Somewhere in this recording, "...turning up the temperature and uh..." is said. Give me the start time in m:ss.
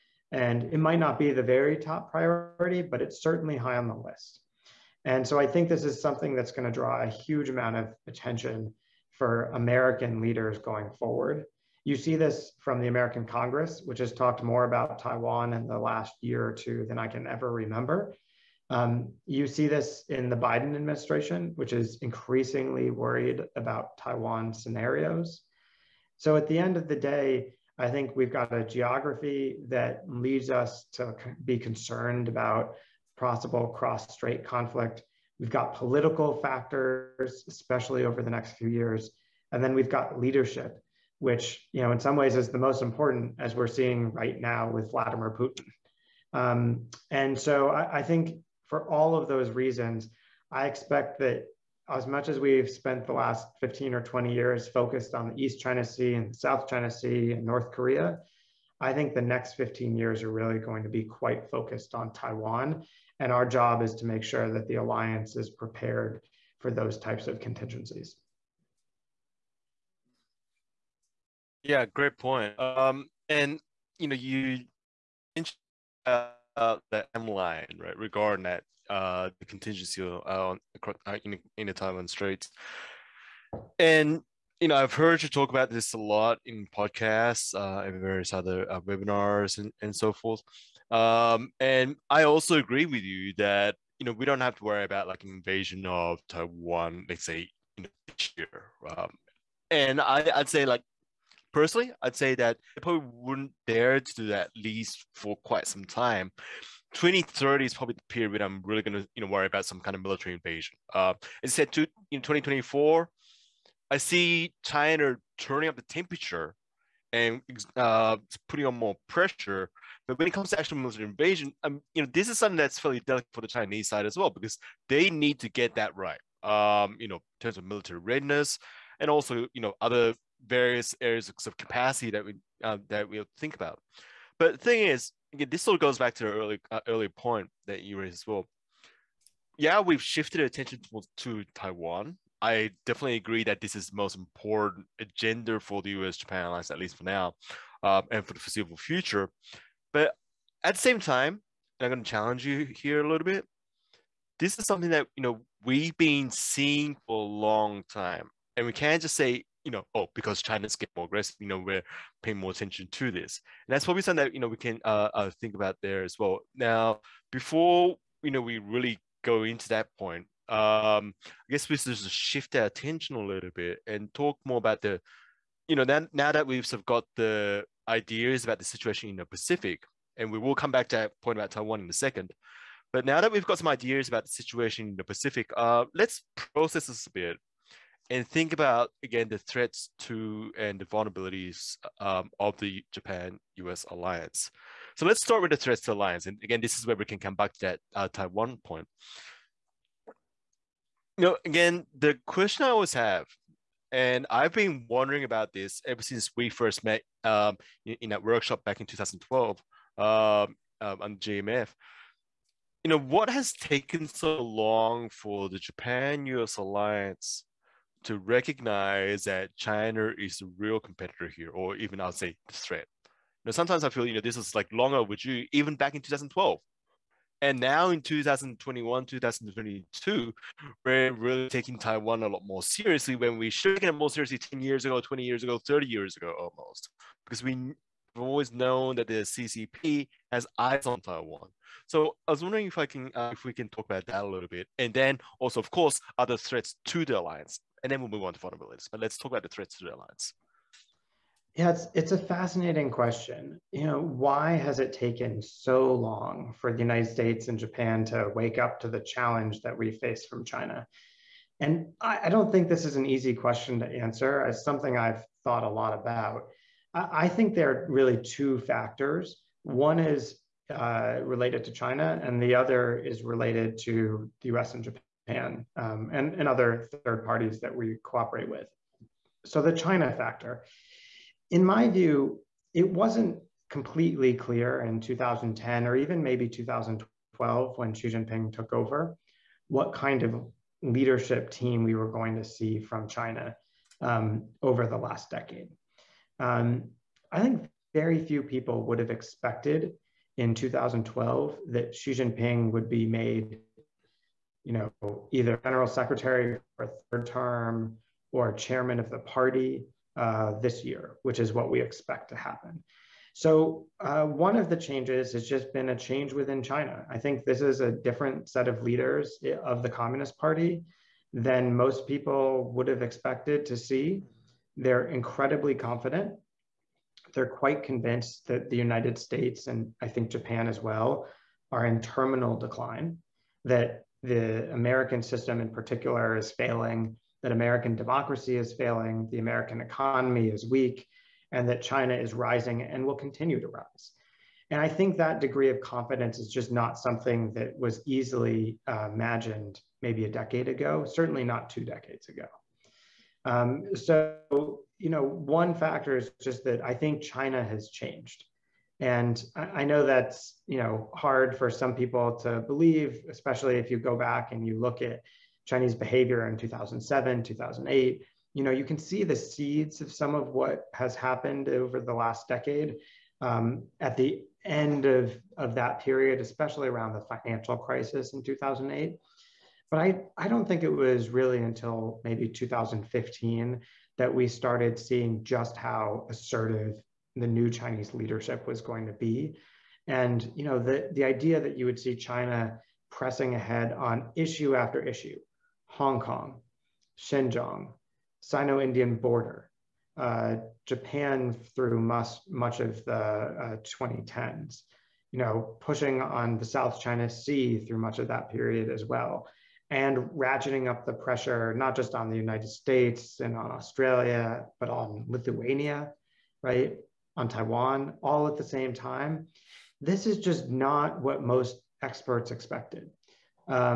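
1:55.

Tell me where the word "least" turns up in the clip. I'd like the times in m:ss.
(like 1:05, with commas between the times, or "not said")
1:44, 2:26.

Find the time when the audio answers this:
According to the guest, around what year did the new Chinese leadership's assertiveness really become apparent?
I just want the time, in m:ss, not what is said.
6:22.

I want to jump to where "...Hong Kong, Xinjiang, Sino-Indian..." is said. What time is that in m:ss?
6:35.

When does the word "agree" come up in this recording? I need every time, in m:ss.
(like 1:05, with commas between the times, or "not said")
1:32, 2:23.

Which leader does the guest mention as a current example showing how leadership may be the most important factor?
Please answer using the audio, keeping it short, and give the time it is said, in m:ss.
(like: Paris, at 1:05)
Vladimir Putin, at 0:44.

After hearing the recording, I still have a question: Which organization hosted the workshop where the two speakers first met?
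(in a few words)
GMF.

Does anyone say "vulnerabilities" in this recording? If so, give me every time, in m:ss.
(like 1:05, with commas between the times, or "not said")
3:10, 4:08.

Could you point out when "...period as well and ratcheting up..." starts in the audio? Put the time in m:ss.
6:48.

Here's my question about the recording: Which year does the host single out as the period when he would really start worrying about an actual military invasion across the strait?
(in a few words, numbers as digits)
2030.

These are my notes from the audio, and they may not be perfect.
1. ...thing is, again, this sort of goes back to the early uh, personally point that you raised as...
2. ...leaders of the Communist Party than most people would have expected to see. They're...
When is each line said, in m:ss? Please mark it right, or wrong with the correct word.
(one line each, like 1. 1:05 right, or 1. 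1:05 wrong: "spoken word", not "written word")
1. 2:14 wrong: "early", not "personally"
2. 5:18 right.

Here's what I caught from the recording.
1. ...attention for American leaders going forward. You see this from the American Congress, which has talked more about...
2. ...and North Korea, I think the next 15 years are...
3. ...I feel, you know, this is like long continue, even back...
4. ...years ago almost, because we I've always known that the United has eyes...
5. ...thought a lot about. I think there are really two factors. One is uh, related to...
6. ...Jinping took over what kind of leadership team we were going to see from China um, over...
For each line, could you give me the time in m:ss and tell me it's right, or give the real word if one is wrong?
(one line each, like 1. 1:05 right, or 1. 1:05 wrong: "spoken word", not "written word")
1. 0:08 right
2. 0:57 right
3. 3:43 wrong: "overdue", not "continue"
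4. 3:55 wrong: "CCP", not "United"
5. 4:25 right
6. 4:48 right.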